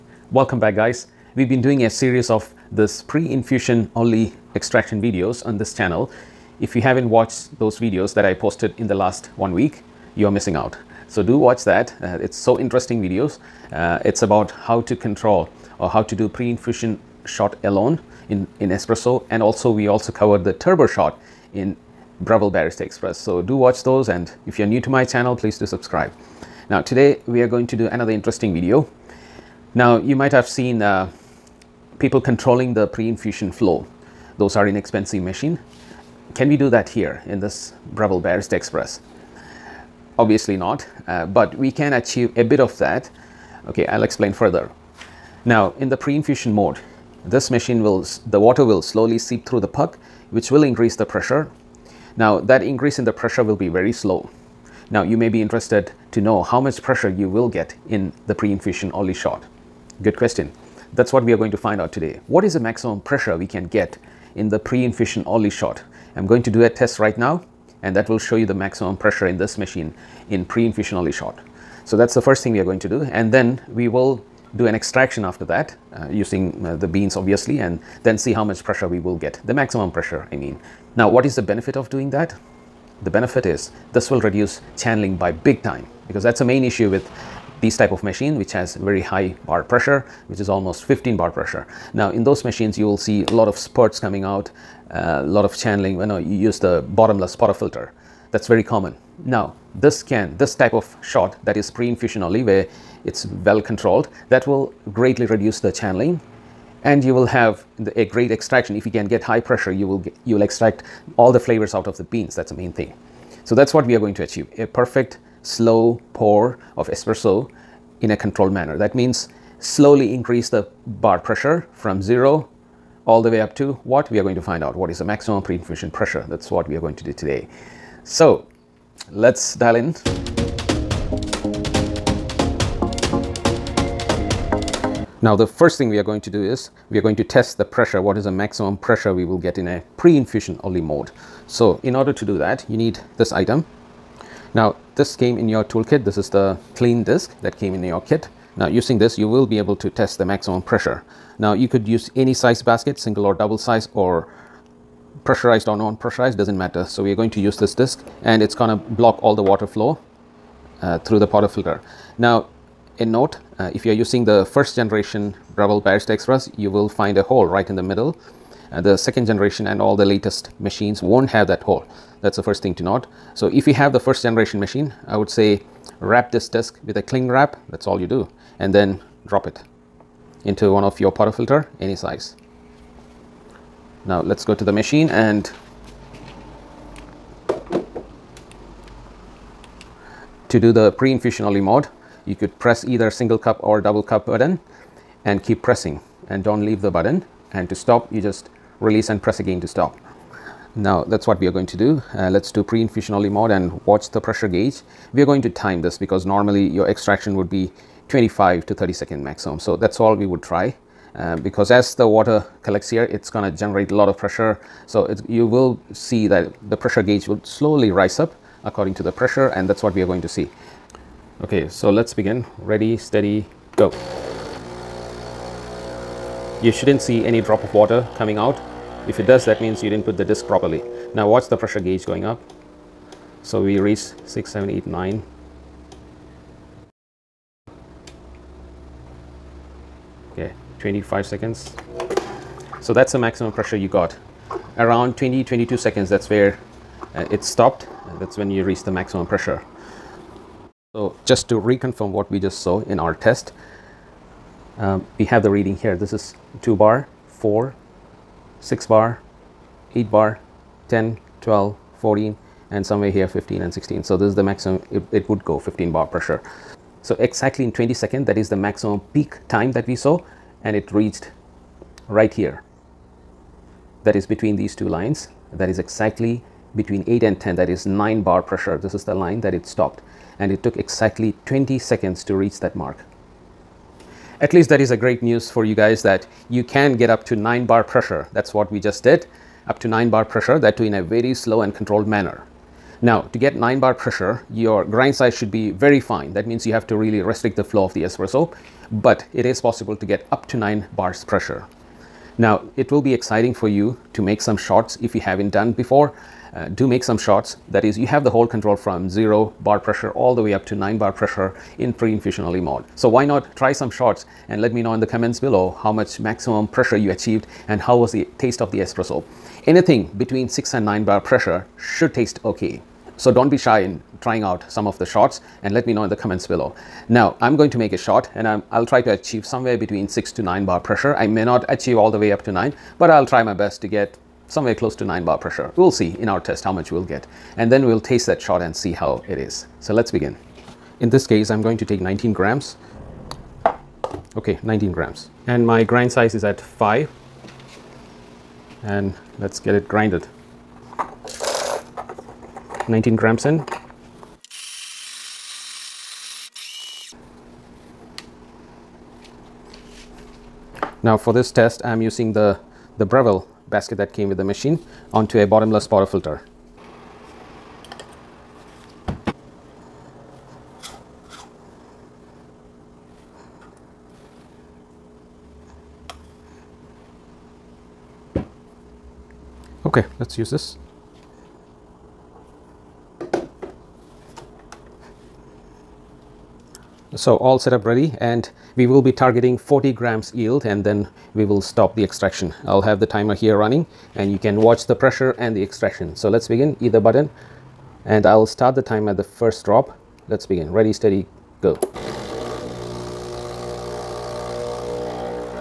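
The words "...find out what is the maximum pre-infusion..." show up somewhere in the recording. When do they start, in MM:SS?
02:04.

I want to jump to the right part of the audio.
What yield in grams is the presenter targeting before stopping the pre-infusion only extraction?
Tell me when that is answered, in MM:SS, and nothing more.
06:29.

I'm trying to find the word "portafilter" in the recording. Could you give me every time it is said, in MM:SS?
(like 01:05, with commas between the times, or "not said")
01:37, 02:41, 03:01, 06:05.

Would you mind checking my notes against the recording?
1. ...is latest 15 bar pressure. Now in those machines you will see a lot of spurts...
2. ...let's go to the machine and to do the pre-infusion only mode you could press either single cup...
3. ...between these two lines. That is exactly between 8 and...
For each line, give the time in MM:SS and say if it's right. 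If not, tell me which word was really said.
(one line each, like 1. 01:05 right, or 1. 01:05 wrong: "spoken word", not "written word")
1. 01:30 wrong: "almost", not "latest"
2. 03:04 right
3. 04:34 right.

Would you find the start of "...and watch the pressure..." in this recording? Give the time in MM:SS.
03:23.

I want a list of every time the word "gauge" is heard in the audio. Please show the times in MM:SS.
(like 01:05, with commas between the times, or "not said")
03:24, 03:37, 03:51.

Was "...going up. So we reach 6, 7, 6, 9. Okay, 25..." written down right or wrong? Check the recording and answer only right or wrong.
wrong.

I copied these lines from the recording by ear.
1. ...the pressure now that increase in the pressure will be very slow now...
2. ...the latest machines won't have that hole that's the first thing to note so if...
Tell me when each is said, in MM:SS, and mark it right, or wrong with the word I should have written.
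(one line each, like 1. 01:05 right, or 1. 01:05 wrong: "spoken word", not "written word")
1. 00:50 right
2. 02:49 right.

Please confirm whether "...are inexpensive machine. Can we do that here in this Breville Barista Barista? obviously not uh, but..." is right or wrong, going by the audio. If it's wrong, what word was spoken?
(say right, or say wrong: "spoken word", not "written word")
wrong: "Express", not "Barista".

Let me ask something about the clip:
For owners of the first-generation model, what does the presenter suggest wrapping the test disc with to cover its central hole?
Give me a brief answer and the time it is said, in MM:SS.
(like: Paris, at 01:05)
cling wrap, at 02:57.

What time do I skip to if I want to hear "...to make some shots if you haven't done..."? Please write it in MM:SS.
05:04.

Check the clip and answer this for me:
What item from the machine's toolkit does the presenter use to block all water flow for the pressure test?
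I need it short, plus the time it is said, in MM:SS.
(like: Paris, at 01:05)
clean disk, at 02:26.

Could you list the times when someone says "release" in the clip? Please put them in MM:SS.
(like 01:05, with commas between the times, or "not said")
03:18.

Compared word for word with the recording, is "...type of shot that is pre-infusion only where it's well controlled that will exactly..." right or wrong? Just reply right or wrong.
wrong.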